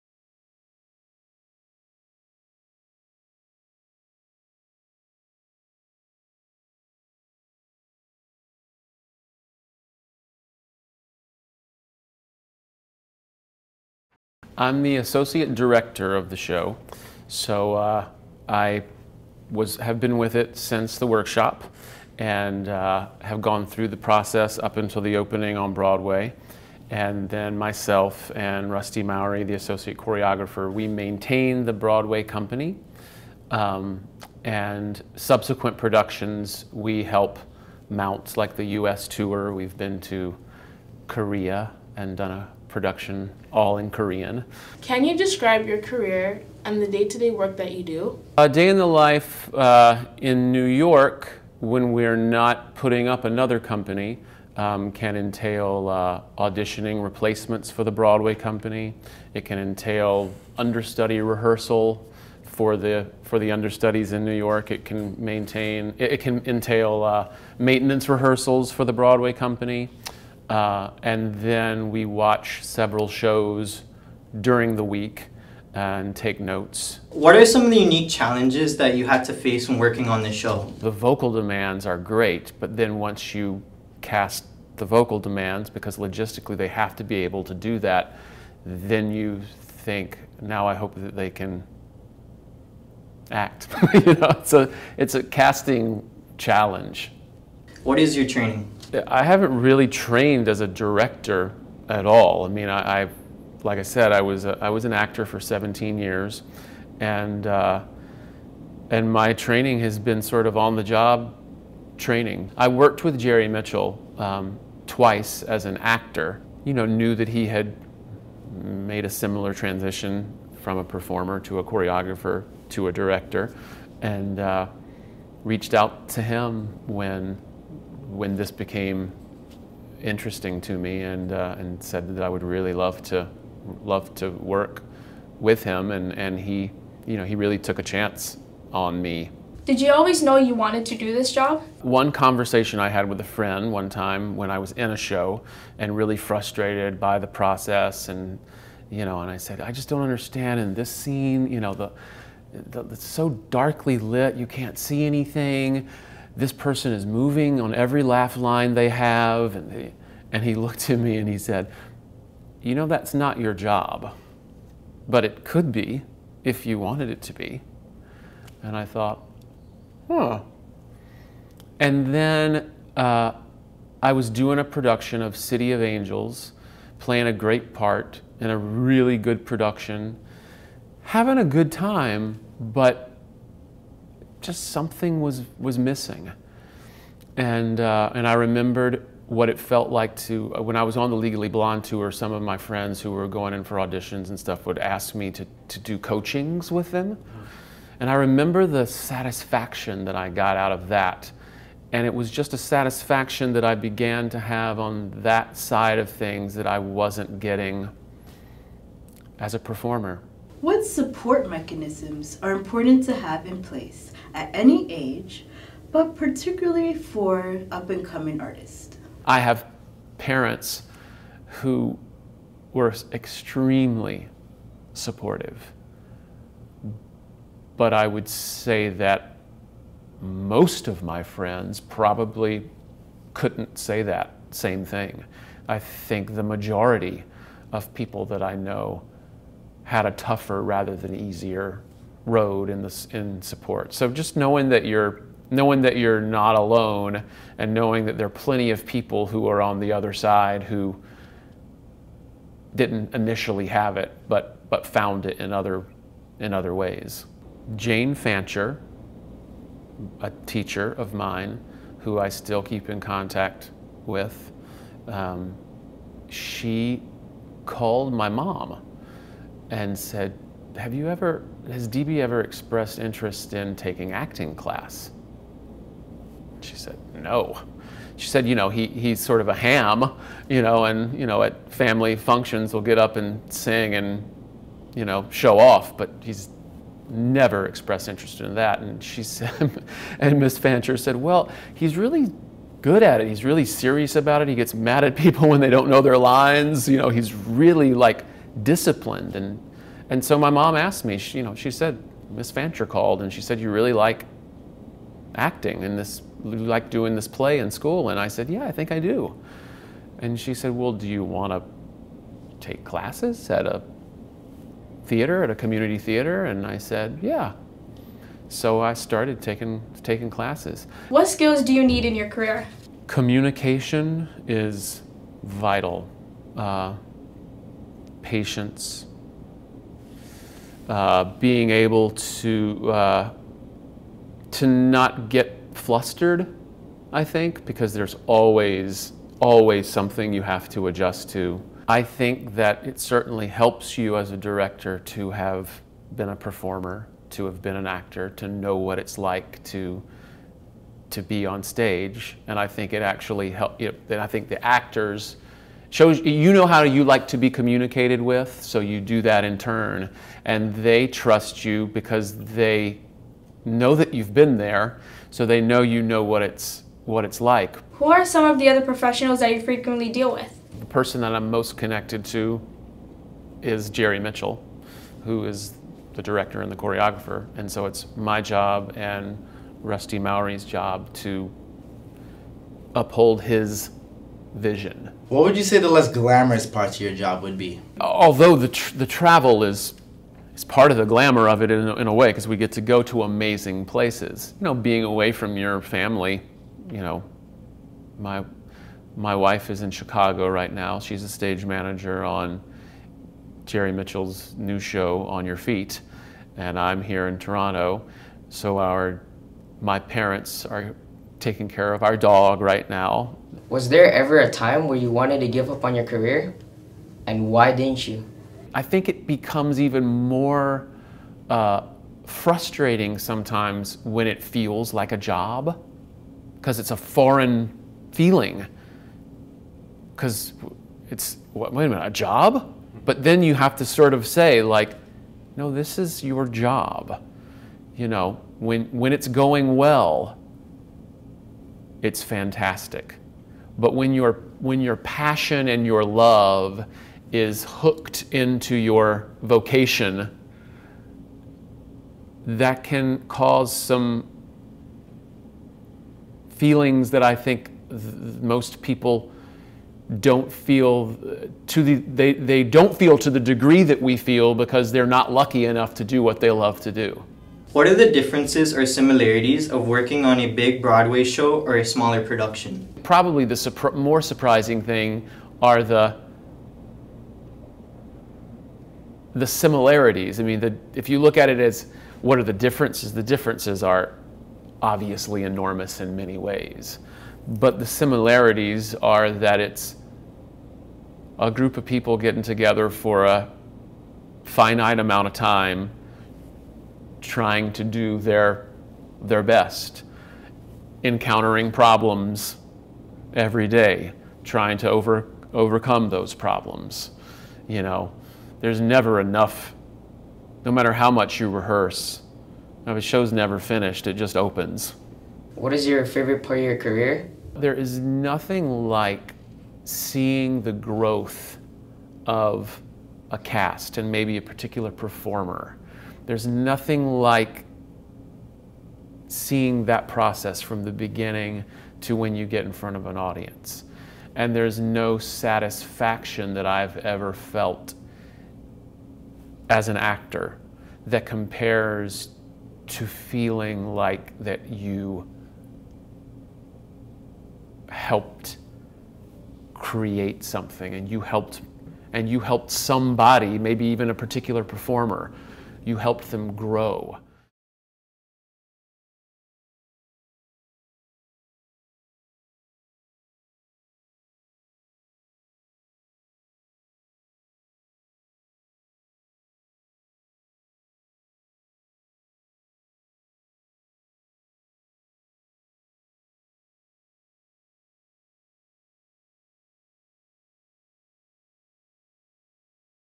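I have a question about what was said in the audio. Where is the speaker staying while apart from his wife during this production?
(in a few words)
Toronto.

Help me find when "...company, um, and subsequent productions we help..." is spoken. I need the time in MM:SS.
00:32.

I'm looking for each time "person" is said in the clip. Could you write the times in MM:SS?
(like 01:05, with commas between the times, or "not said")
02:36, 06:10.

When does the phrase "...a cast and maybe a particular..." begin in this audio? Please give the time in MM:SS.
08:43.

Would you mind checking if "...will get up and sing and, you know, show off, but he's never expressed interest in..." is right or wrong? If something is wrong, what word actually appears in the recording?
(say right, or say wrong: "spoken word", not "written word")
right.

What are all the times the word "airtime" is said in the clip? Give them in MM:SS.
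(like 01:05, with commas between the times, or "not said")
not said.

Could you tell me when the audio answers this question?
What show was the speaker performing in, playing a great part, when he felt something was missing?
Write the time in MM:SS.
02:55.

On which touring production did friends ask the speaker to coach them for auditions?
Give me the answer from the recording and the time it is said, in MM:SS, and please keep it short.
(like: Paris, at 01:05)
Legally Blonde, at 03:11.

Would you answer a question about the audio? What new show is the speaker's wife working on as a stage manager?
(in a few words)
On Your Feet.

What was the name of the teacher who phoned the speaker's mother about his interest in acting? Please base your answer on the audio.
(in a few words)
Jane Fancher.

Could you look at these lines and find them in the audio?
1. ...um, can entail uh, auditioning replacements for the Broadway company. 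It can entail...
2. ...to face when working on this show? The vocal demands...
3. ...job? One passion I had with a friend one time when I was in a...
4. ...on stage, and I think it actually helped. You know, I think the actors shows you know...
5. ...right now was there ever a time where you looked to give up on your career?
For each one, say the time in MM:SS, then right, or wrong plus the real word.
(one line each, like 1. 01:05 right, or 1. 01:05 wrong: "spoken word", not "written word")
1. 00:54 right
2. 01:19 right
3. 02:21 wrong: "conversation", not "passion"
4. 05:51 right
5. 06:52 wrong: "wanted", not "looked".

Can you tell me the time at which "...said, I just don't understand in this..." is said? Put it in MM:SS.
02:29.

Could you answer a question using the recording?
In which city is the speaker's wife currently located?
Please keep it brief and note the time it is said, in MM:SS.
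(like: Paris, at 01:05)
Chicago, at 06:39.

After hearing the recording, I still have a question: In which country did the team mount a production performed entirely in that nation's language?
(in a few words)
Korea.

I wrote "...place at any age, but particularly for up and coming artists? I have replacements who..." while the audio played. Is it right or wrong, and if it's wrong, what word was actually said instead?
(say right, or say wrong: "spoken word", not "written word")
wrong: "parents", not "replacements".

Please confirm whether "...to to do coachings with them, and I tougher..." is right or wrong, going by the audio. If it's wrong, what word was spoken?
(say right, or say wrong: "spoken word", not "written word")
wrong: "remember", not "tougher".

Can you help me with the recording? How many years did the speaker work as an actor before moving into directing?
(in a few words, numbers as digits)
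17.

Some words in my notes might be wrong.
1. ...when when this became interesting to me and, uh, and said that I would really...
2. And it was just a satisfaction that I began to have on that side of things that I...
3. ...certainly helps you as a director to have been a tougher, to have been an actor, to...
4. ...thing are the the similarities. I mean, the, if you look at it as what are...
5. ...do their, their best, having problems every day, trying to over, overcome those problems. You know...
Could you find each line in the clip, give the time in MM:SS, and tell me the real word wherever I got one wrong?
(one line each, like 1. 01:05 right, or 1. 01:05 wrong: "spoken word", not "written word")
1. 02:06 right
2. 03:21 right
3. 05:42 wrong: "performer", not "tougher"
4. 07:54 right
5. 08:17 wrong: "encountering", not "having".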